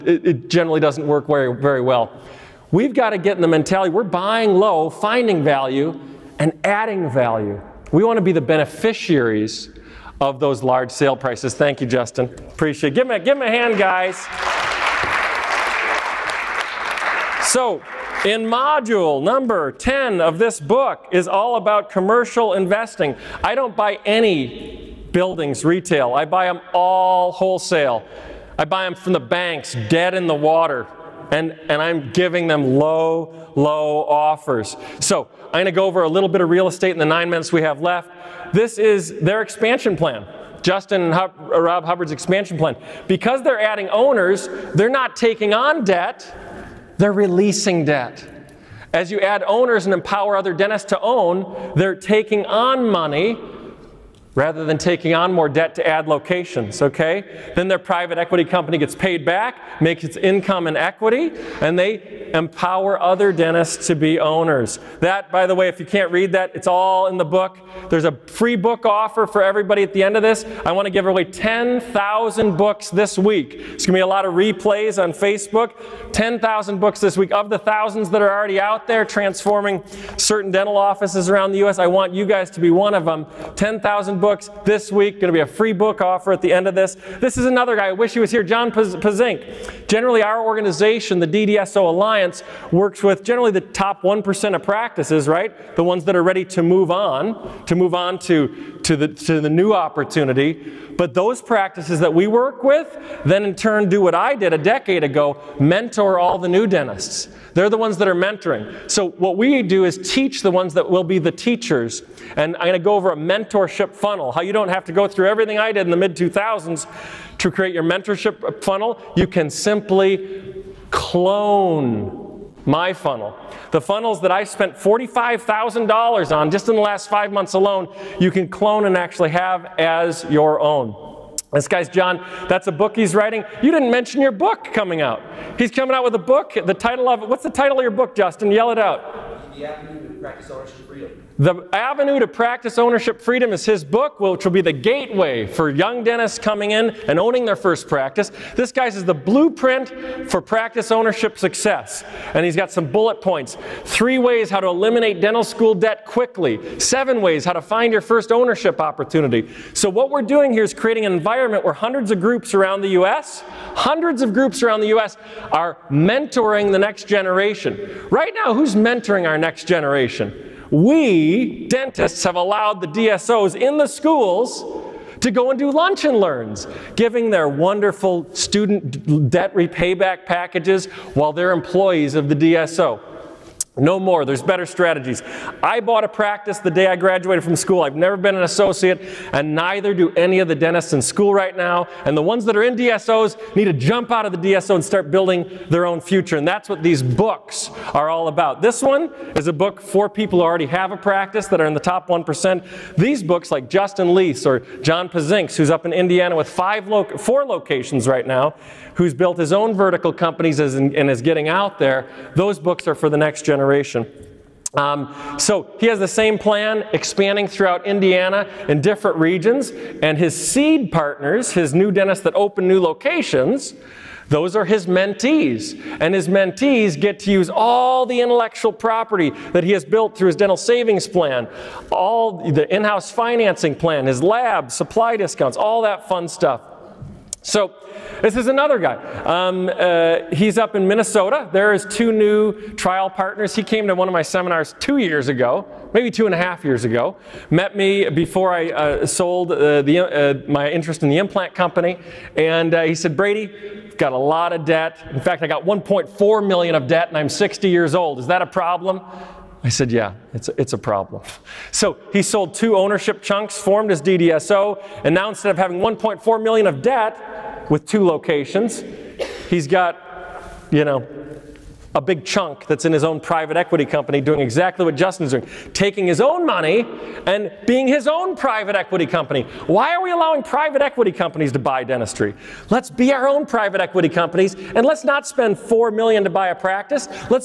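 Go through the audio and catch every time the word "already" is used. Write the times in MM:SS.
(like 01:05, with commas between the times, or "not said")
01:18, 03:20.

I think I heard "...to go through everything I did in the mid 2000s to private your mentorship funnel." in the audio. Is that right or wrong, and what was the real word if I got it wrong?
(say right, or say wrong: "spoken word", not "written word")
wrong: "create", not "private".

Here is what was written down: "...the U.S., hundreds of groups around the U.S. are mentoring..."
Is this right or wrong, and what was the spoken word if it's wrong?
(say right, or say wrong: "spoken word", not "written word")
right.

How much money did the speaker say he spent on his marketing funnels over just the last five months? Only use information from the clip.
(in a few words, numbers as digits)
$45,000.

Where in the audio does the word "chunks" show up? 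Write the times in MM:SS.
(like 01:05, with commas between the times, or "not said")
04:23, 04:32.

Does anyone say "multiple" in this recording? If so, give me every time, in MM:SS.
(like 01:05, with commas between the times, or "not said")
not said.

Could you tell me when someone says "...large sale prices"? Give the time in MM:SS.
00:10.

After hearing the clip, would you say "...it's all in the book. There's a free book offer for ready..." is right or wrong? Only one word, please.
wrong.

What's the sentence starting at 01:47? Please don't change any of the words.
They're the ones that are mentoring.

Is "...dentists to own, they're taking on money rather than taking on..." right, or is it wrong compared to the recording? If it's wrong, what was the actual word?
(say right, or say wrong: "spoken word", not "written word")
right.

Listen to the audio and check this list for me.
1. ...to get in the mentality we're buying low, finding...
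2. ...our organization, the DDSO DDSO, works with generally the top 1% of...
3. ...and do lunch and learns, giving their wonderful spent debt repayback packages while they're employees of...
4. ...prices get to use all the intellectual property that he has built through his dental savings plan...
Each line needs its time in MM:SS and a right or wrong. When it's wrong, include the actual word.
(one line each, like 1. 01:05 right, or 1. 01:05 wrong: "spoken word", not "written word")
1. 00:03 right
2. 01:30 wrong: "Alliance", not "DDSO"
3. 02:55 wrong: "student", not "spent"
4. 03:46 wrong: "mentees", not "prices".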